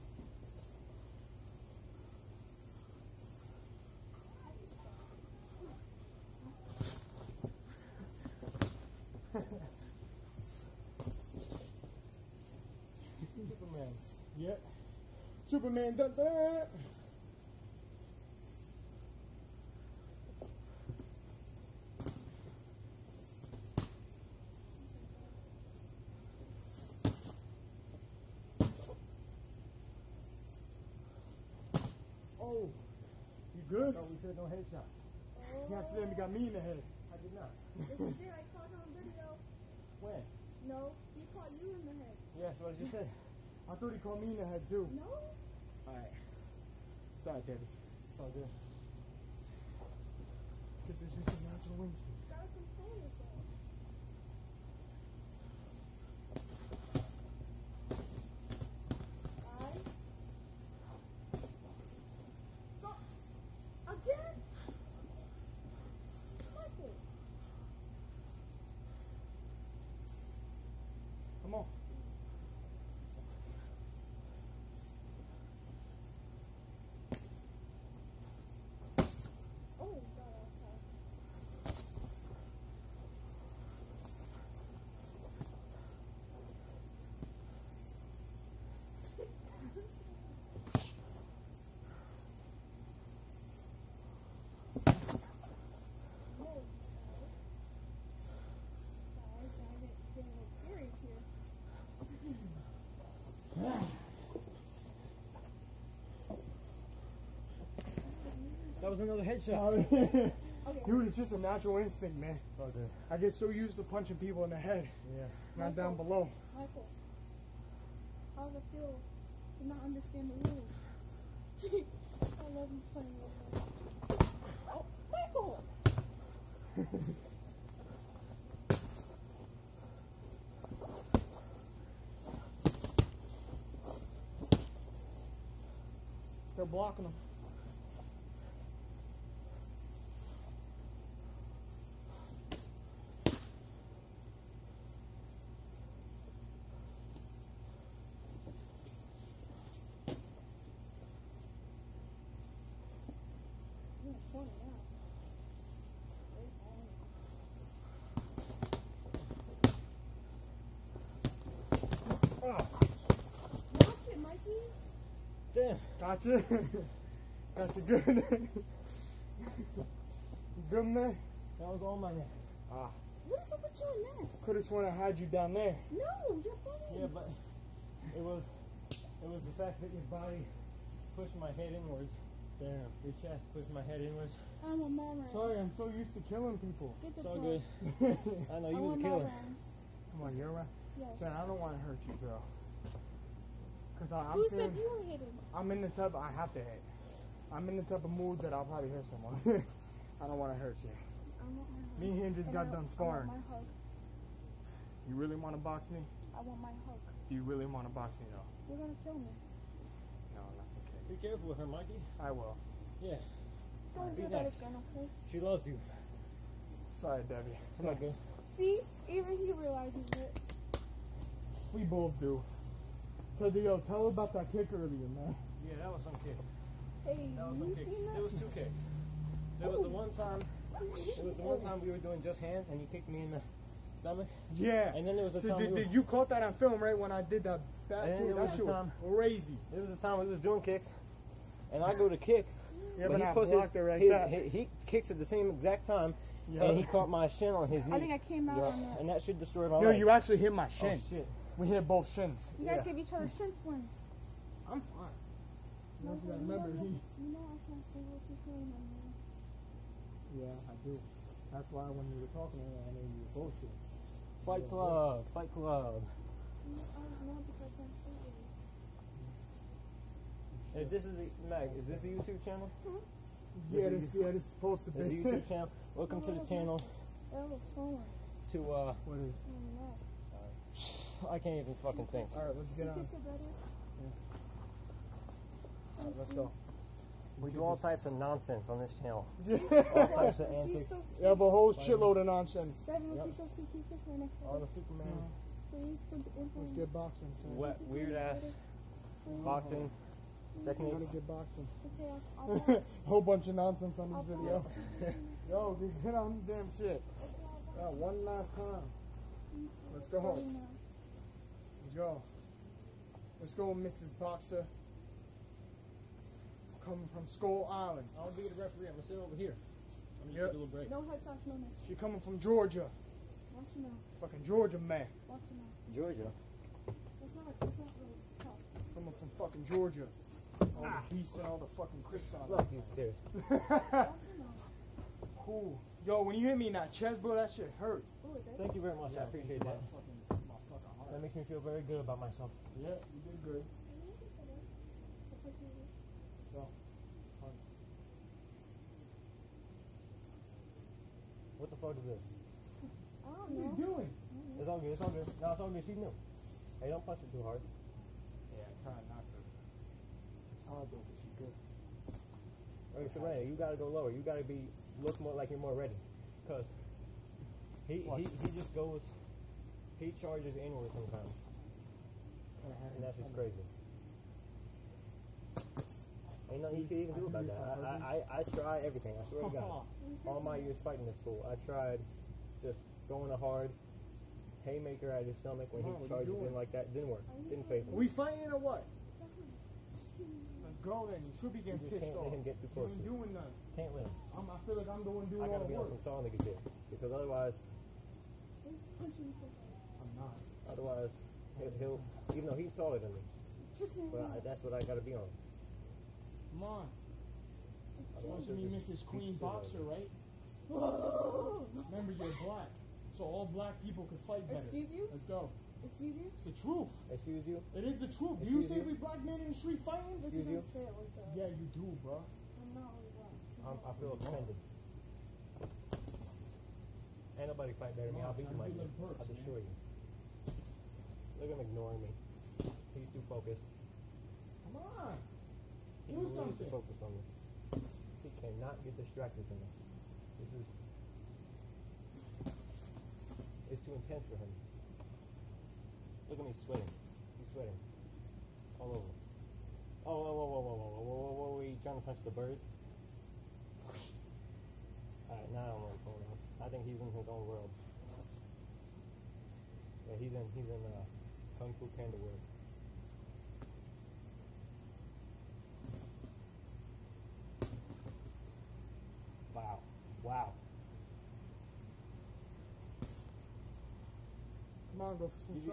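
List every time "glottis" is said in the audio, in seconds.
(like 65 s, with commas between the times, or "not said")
not said.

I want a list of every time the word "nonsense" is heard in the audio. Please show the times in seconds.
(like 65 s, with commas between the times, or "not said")
288 s, 292 s, 303 s.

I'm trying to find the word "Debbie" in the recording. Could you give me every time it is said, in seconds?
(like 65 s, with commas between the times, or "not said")
47 s, 217 s.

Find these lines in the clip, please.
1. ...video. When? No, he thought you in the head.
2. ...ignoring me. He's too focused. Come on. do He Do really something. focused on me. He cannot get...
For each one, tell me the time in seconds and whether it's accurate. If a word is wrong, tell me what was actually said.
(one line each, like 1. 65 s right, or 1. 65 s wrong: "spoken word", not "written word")
1. 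38 s wrong: "caught", not "thought"
2. 431 s right.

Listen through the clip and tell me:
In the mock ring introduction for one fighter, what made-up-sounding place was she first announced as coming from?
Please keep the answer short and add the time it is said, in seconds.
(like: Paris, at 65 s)
Skull Island, at 317 s.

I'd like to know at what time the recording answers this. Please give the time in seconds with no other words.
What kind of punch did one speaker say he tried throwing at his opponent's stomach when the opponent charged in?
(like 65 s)
384 s.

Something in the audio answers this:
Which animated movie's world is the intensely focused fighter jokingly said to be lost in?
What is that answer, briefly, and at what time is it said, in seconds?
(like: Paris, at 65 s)
Kung Fu Panda, at 461 s.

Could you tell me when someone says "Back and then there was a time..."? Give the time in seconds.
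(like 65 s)
237 s.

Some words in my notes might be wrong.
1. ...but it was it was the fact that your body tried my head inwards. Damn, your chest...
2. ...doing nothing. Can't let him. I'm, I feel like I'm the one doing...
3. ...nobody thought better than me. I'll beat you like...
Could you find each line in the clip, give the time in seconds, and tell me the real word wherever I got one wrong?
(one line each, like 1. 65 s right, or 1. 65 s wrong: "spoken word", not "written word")
1. 177 s wrong: "pushed", not "tried"
2. 393 s right
3. 427 s wrong: "fight", not "thought".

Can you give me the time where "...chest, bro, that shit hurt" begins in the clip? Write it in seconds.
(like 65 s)
336 s.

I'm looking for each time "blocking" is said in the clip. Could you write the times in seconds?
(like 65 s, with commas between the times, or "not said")
136 s.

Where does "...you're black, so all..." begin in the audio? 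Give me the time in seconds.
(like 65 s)
412 s.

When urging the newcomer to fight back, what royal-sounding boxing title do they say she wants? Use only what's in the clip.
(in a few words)
Mrs. Queen Boxer.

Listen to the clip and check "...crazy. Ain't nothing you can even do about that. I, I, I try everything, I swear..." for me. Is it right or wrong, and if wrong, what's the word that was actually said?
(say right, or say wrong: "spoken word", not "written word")
right.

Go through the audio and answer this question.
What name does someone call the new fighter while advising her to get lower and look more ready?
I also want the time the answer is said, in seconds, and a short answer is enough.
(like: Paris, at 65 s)
Serena, at 363 s.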